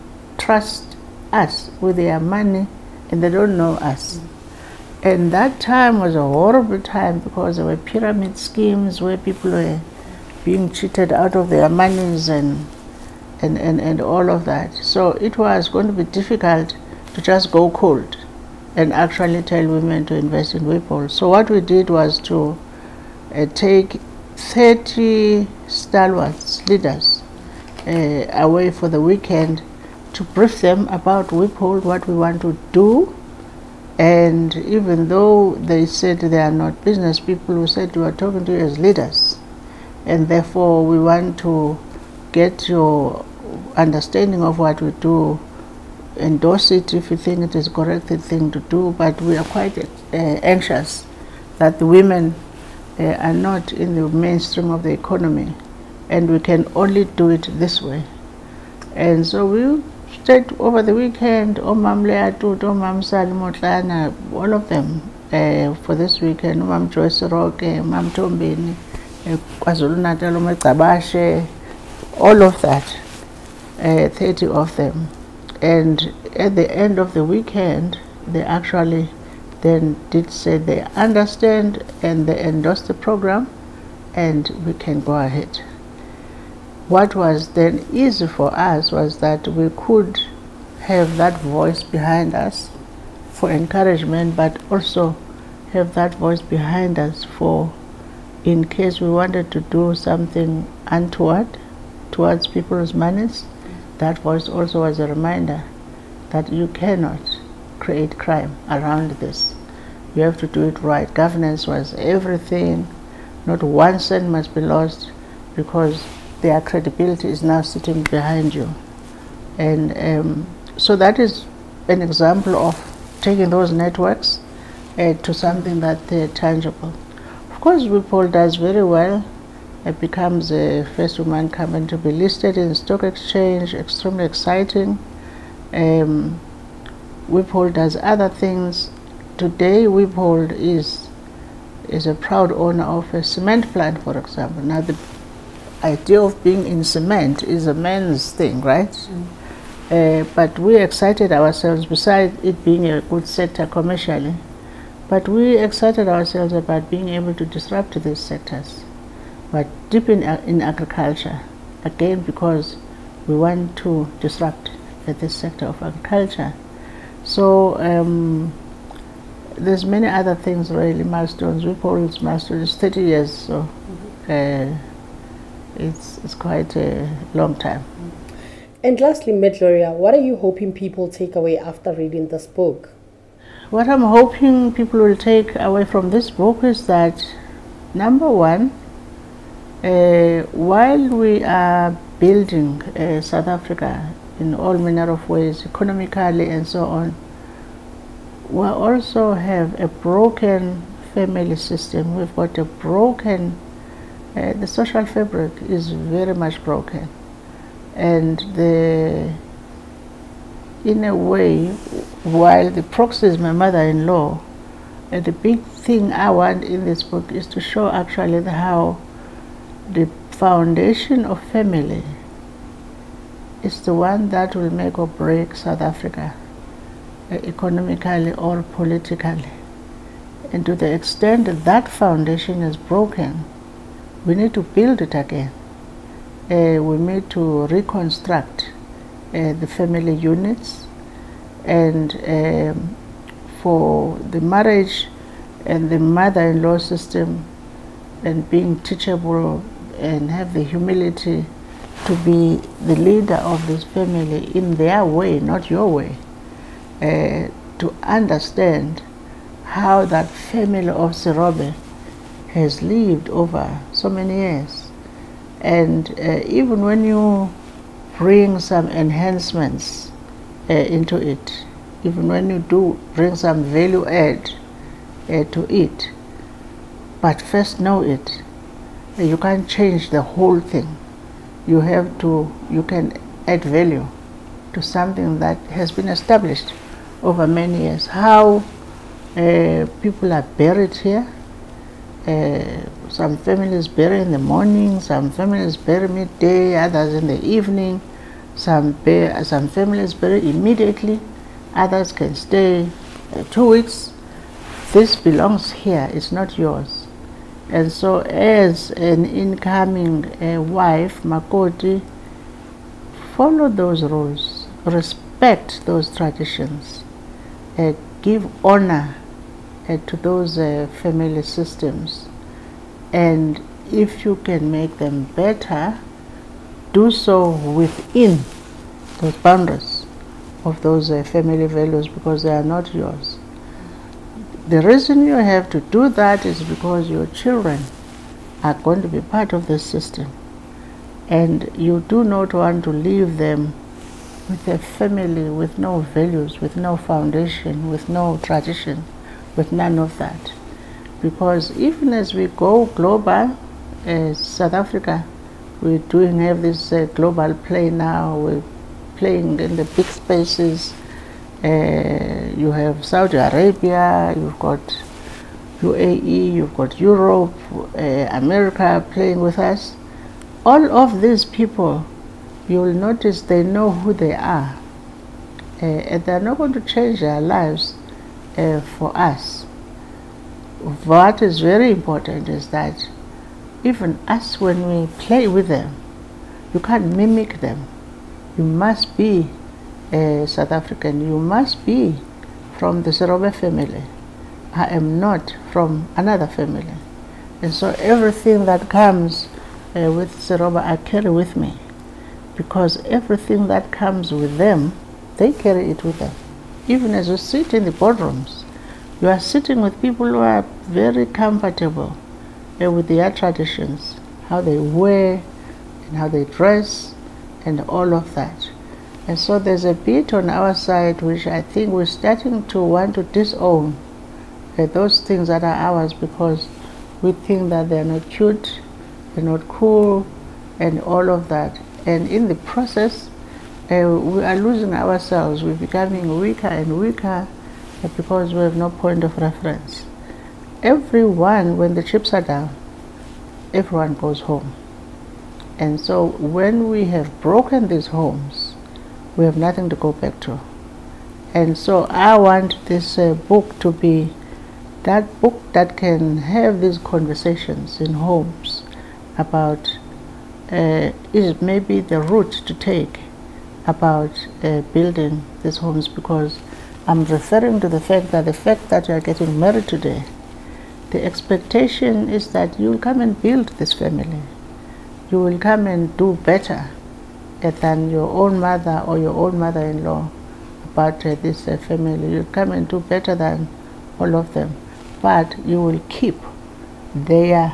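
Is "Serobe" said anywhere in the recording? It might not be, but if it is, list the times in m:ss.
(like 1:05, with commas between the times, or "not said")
4:21, 6:33, 6:40.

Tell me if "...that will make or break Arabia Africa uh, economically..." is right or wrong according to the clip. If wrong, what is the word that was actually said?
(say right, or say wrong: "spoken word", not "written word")
wrong: "South", not "Arabia".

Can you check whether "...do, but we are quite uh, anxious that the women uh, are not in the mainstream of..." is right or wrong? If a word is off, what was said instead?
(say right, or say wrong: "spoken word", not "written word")
right.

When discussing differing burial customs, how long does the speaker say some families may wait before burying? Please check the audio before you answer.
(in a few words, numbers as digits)
2 weeks.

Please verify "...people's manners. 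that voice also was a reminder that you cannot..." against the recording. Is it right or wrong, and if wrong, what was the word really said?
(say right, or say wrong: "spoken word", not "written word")
right.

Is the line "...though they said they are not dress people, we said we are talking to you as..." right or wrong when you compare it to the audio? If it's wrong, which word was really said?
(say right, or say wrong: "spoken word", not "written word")
wrong: "business", not "dress".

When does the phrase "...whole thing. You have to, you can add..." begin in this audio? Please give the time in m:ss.
4:40.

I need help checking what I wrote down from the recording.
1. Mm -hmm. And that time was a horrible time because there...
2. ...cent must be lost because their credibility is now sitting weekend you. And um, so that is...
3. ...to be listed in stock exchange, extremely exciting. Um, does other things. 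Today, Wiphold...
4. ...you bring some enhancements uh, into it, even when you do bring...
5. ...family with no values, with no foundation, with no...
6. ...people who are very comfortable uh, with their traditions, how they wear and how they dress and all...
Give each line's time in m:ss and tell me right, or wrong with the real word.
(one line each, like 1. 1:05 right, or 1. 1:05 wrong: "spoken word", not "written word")
1. 0:04 right
2. 1:53 wrong: "behind", not "weekend"
3. 2:11 right
4. 4:27 right
5. 5:44 right
6. 6:50 right.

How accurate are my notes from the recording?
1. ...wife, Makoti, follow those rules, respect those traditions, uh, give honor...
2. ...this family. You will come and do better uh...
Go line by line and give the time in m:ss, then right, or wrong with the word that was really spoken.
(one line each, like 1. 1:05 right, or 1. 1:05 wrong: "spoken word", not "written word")
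1. 5:10 right
2. 7:53 right.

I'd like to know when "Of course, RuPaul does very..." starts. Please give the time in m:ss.
2:07.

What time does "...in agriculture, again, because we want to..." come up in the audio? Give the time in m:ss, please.
2:40.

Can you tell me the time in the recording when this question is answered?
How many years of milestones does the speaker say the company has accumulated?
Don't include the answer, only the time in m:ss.
2:52.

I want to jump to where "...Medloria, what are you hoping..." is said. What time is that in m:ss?
2:59.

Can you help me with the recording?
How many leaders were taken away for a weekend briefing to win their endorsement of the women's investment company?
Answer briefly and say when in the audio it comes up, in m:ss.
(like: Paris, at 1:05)
30, at 0:24.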